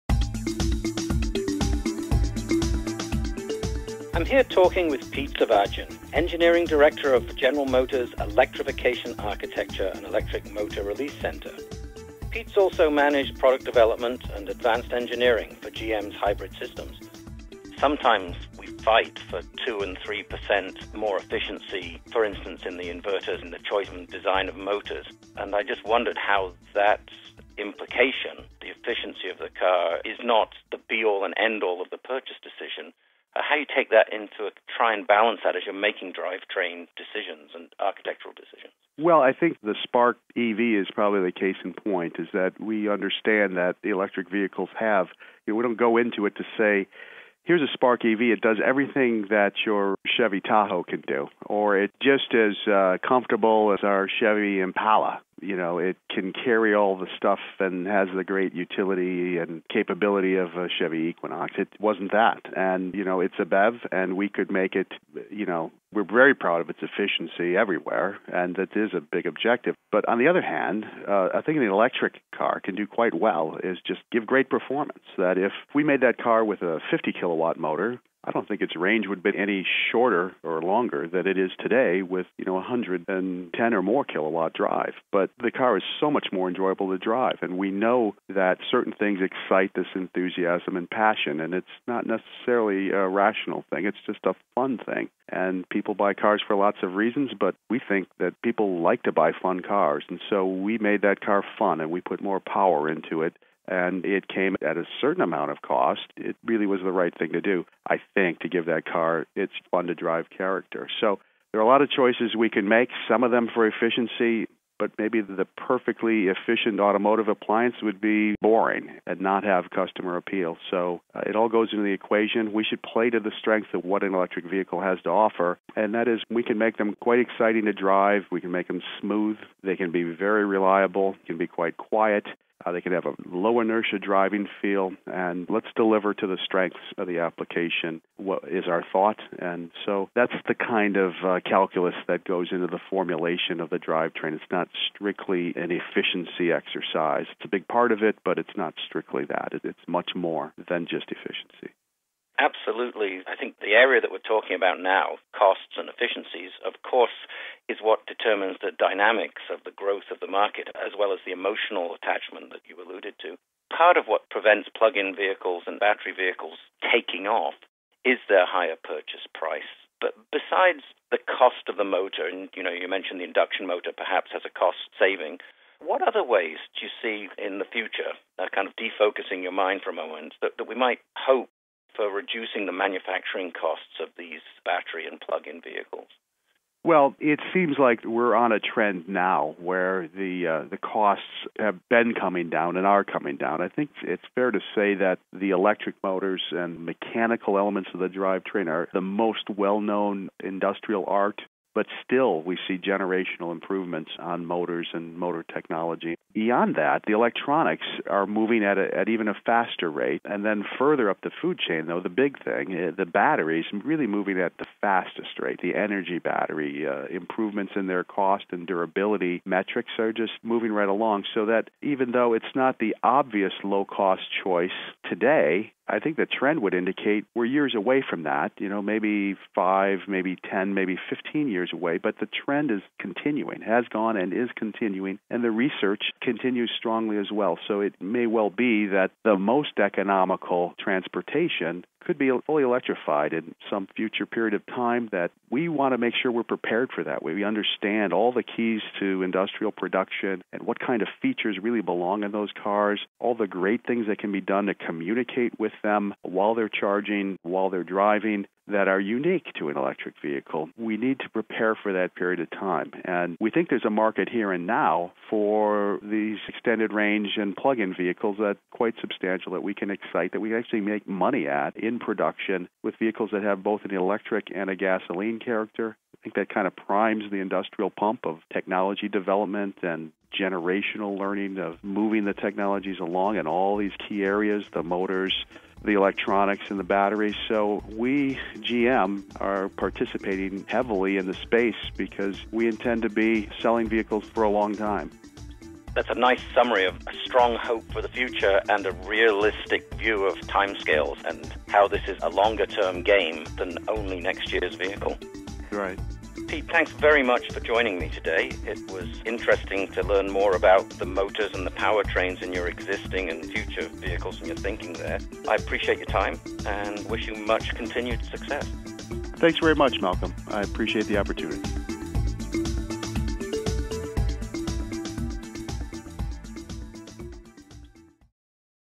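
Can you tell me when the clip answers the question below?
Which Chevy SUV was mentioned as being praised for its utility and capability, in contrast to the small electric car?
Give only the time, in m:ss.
1:00.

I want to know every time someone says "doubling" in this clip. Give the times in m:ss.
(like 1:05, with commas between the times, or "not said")
not said.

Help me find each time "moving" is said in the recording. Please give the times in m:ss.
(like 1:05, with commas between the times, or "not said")
3:28, 3:34, 3:40, 4:41.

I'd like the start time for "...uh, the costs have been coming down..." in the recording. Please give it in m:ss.
3:10.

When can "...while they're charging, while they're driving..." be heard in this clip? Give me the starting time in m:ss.
4:16.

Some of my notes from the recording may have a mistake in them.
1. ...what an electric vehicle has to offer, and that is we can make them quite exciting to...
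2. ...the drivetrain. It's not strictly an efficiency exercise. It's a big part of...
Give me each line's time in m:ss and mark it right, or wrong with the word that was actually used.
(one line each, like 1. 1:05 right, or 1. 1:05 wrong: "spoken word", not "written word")
1. 2:03 right
2. 2:23 right.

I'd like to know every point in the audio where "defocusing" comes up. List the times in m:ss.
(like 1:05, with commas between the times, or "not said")
2:58.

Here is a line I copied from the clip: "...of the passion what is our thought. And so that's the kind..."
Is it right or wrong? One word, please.
wrong.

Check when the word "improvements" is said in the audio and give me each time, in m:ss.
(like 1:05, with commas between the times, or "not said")
3:23, 3:37.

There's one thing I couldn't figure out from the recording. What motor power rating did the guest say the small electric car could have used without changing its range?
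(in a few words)
50 kilowatts.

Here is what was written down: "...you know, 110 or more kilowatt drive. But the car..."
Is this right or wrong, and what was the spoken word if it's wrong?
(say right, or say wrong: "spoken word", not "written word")
right.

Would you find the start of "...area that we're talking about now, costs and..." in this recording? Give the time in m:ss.
2:33.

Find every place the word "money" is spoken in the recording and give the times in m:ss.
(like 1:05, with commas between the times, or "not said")
4:31.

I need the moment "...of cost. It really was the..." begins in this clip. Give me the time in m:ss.
1:45.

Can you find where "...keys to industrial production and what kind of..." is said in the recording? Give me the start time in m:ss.
4:08.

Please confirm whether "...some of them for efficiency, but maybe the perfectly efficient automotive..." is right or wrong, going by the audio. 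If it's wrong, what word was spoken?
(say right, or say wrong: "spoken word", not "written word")
right.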